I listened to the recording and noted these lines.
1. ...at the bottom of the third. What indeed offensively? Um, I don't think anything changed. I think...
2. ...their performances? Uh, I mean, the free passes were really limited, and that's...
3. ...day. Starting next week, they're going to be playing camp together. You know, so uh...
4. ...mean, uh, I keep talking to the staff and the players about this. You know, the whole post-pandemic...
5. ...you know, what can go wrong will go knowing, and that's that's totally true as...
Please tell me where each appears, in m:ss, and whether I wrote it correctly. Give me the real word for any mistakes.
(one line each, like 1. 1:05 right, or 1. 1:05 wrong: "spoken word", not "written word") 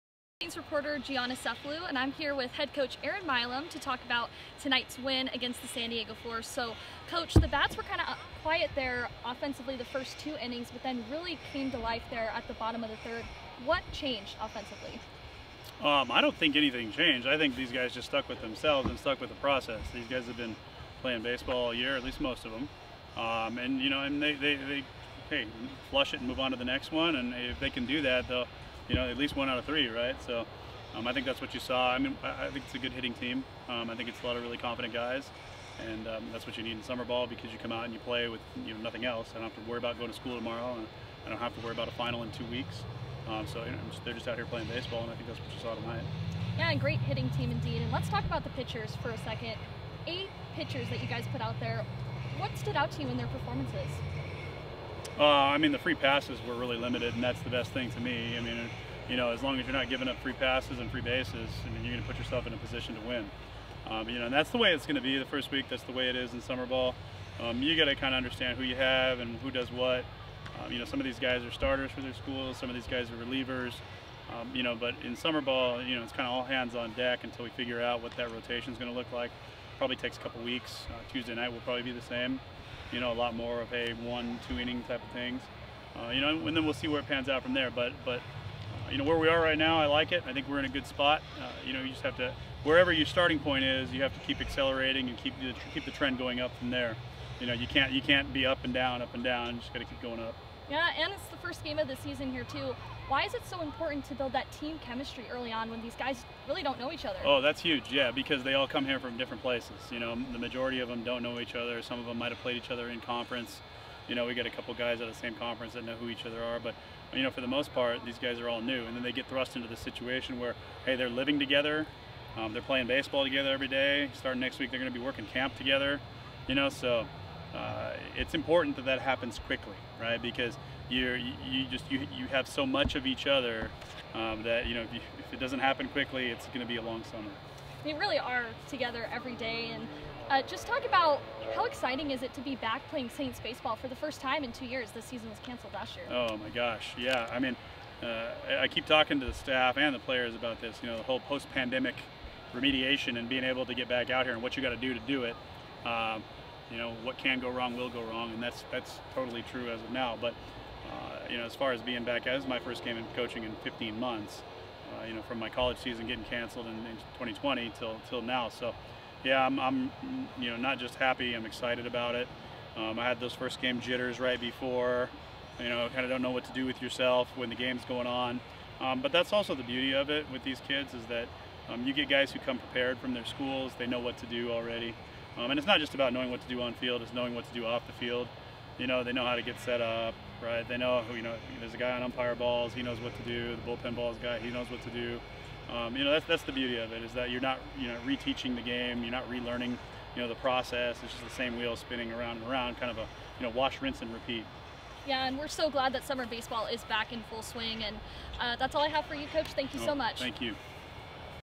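1. 0:12 wrong: "changed", not "indeed"
2. 0:53 right
3. 2:03 wrong: "working", not "playing"
4. 2:27 right
5. 2:36 wrong: "wrong", not "knowing".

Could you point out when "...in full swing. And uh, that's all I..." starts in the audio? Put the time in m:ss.
3:27.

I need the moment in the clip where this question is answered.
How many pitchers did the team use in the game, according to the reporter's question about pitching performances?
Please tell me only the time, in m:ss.
0:50.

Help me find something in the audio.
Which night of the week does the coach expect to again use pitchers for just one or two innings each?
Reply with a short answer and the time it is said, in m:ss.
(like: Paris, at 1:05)
Tuesday, at 1:21.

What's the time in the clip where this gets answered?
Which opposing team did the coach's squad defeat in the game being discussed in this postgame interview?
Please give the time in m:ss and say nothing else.
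0:05.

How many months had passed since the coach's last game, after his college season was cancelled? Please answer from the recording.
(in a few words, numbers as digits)
15.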